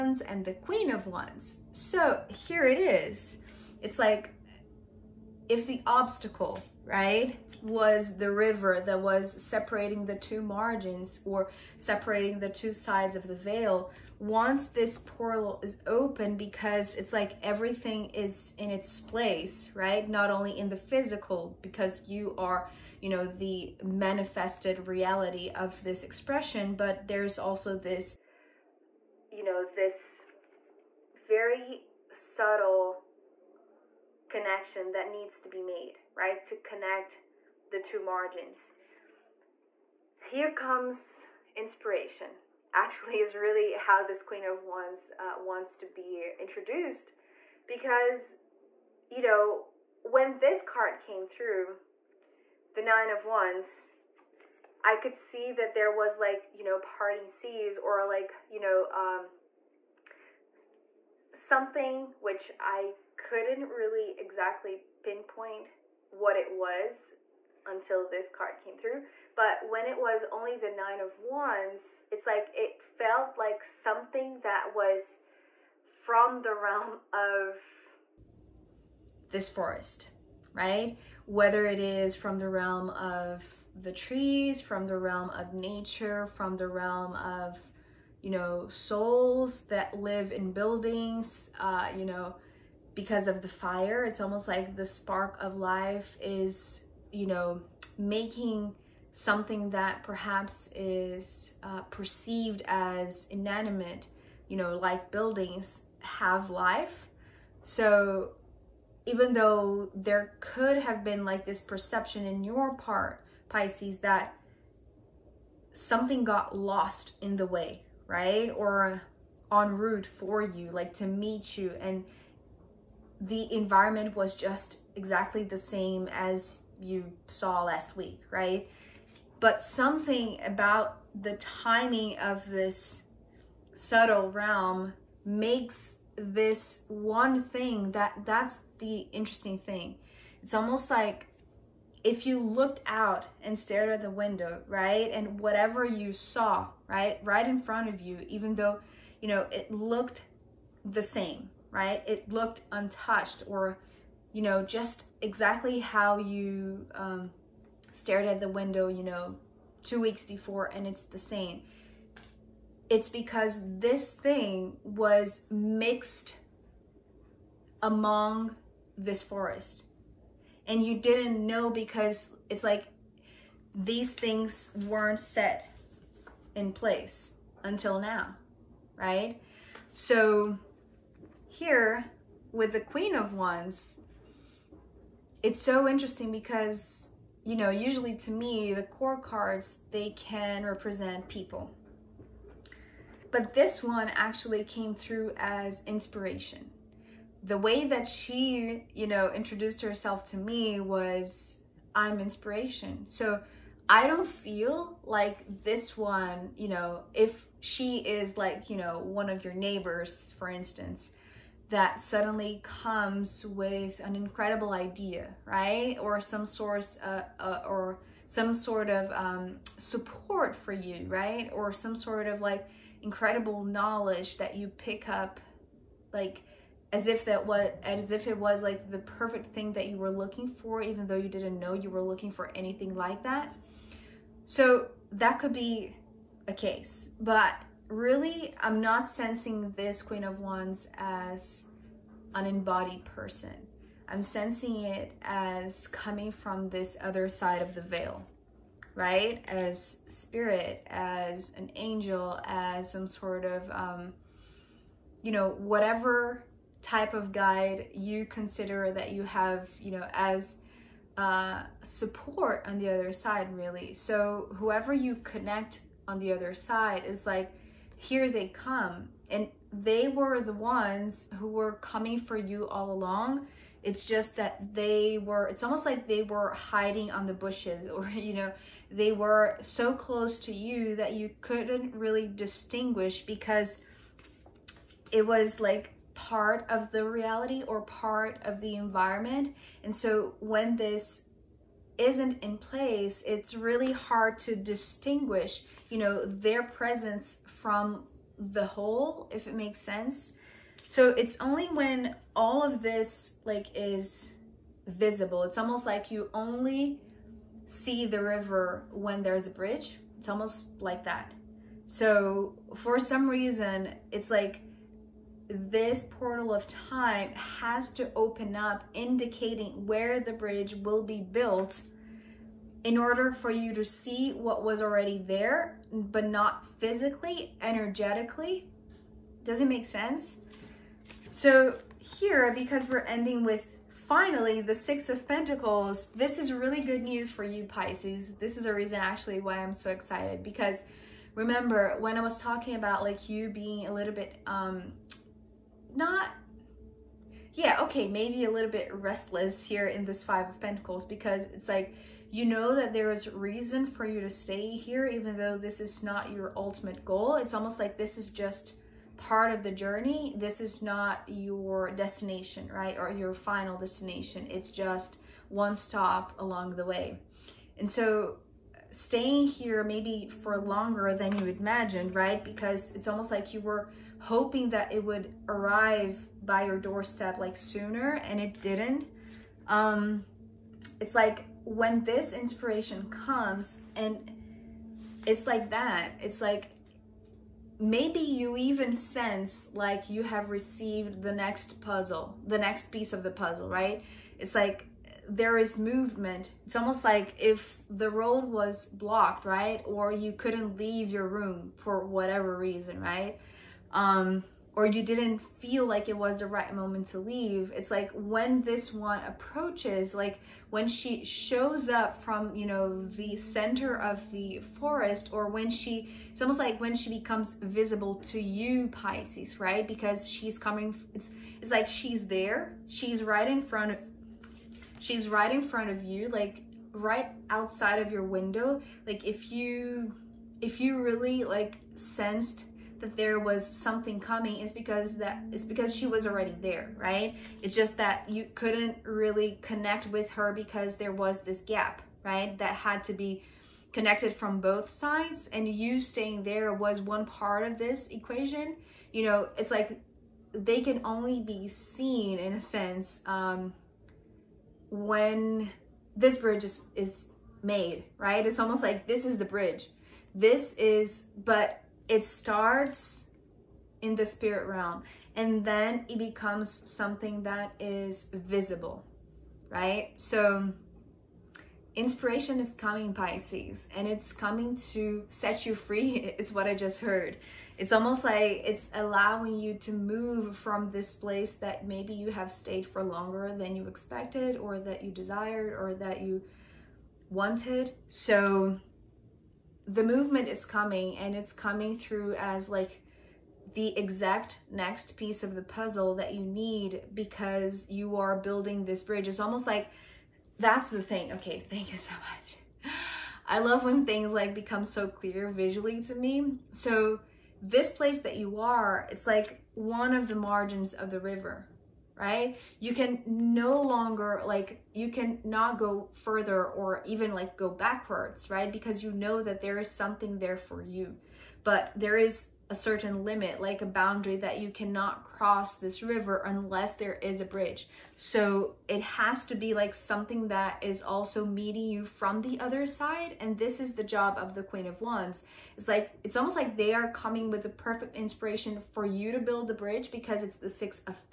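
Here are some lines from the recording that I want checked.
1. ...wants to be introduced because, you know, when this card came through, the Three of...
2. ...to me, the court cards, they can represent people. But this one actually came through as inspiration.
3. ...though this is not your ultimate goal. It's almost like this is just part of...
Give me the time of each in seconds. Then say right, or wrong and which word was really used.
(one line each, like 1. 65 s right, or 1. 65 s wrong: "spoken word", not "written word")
1. 45 s wrong: "Nine", not "Three"
2. 188 s right
3. 355 s right.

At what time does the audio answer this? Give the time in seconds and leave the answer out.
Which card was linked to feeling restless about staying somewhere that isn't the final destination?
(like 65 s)
350 s.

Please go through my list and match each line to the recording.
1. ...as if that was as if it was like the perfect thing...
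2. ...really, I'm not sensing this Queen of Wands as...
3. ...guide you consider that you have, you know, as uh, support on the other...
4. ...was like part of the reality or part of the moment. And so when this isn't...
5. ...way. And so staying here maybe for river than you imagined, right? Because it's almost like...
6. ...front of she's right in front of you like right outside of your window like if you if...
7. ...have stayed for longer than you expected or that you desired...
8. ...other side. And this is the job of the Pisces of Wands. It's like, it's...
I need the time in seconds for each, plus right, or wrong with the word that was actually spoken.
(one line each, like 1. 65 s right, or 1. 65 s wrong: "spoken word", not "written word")
1. 226 s right
2. 237 s right
3. 257 s right
4. 285 s wrong: "environment", not "moment"
5. 366 s wrong: "longer", not "river"
6. 423 s right
7. 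482 s right
8. 532 s wrong: "Queen", not "Pisces".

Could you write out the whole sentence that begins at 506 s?
So this place that you are, it's like one of the margins of the river right?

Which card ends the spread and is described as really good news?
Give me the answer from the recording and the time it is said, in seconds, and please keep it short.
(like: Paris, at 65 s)
Six of Pentacles, at 334 s.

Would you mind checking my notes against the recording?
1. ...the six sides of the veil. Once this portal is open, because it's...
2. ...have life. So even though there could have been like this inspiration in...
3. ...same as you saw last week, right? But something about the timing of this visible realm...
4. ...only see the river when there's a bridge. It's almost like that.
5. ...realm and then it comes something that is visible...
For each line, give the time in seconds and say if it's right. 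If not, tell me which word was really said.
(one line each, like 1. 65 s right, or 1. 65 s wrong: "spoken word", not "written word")
1. 12 s wrong: "two", not "six"
2. 105 s wrong: "perception", not "inspiration"
3. 125 s wrong: "subtle", not "visible"
4. 306 s right
5. 464 s wrong: "becomes", not "comes".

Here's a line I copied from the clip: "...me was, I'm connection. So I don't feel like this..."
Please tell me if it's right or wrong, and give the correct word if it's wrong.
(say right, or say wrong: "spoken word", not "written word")
wrong: "inspiration", not "connection".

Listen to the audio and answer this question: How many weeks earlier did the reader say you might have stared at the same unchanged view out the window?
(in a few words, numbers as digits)
2.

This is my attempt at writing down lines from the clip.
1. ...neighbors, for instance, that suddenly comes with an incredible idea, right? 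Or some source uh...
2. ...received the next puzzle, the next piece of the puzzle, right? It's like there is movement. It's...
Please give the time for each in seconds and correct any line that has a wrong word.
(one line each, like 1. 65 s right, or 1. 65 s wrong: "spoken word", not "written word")
1. 209 s right
2. 390 s right.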